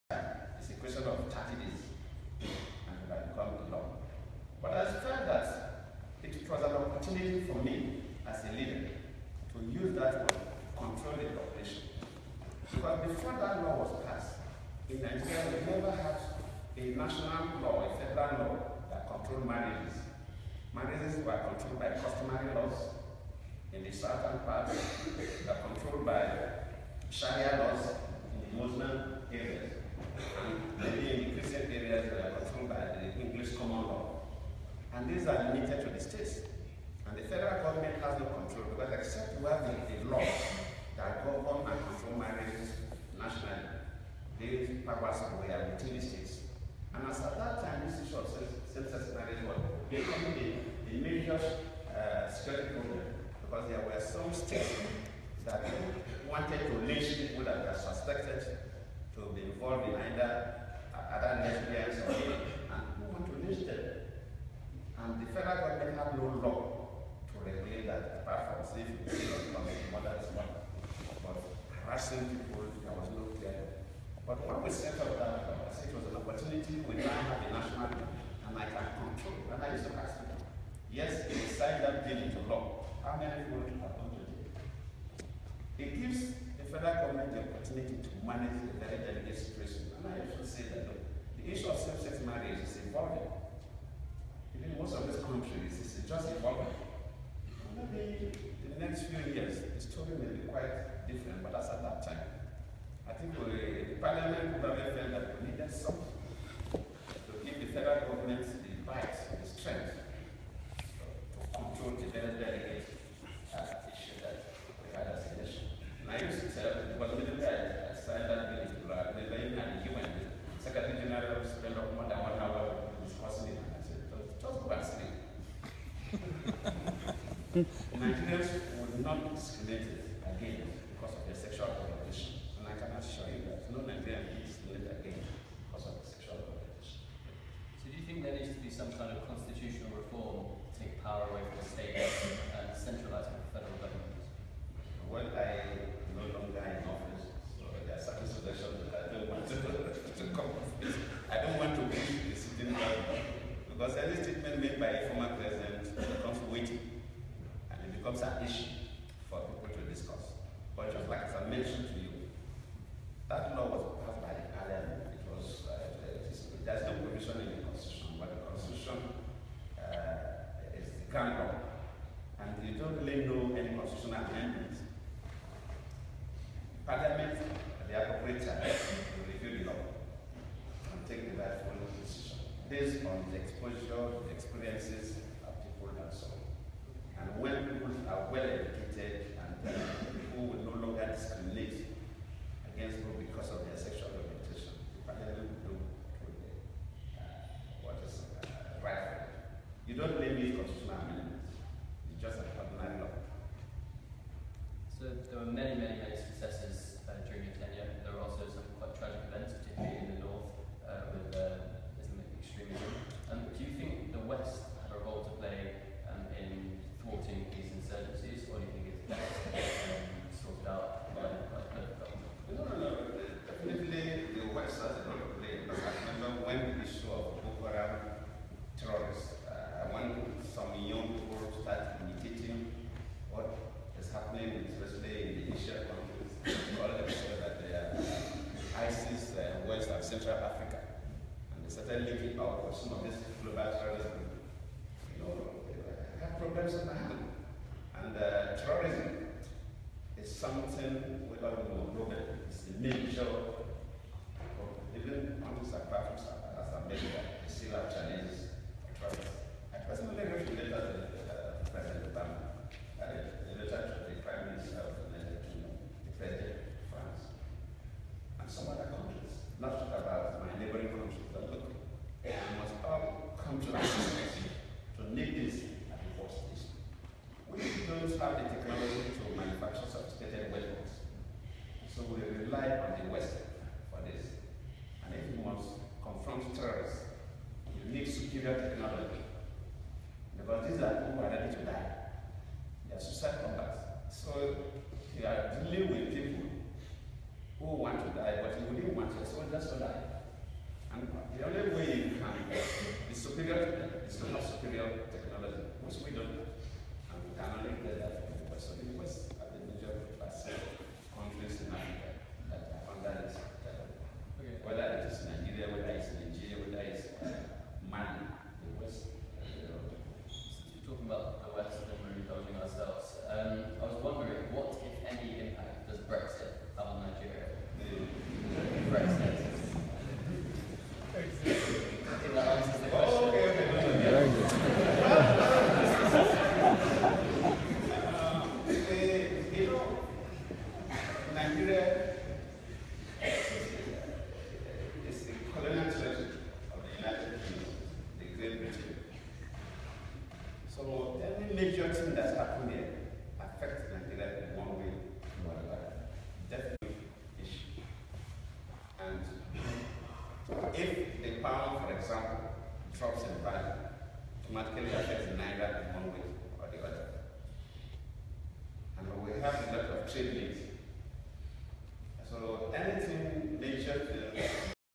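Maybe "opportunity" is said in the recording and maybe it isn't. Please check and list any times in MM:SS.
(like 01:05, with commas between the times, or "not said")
00:06, 01:16, 01:27.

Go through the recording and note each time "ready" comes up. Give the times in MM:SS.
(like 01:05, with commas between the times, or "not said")
04:51.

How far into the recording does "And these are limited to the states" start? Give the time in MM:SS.
00:34.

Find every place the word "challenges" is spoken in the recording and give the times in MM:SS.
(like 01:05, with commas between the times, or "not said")
04:17.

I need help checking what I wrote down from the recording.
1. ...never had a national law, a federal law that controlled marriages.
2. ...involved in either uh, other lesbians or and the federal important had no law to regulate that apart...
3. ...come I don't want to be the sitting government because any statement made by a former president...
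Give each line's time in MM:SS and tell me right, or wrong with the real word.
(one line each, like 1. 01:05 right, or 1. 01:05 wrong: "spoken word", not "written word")
1. 00:15 right
2. 00:59 wrong: "government", not "important"
3. 02:30 right.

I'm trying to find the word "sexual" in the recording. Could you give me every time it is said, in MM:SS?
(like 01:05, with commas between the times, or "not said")
02:11, 02:16, 03:13.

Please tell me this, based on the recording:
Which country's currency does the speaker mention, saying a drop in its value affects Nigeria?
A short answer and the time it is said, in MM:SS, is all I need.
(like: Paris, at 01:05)
The pound, at 06:01.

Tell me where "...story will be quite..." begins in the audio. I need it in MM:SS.
01:39.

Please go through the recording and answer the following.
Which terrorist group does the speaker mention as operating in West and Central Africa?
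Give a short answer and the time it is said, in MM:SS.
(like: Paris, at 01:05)
ISIS, at 03:58.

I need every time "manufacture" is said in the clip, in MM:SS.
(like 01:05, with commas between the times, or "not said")
04:39.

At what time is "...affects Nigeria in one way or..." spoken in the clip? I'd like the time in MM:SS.
05:53.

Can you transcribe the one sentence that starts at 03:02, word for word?
based on the exposure, experiences of people and so on.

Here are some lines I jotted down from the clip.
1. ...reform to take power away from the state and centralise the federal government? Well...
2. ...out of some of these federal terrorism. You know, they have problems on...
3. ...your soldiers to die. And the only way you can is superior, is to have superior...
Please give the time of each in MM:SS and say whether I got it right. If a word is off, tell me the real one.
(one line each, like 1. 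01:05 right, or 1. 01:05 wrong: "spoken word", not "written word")
1. 02:19 right
2. 04:02 wrong: "global", not "federal"
3. 04:59 right.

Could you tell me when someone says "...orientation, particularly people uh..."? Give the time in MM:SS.
03:14.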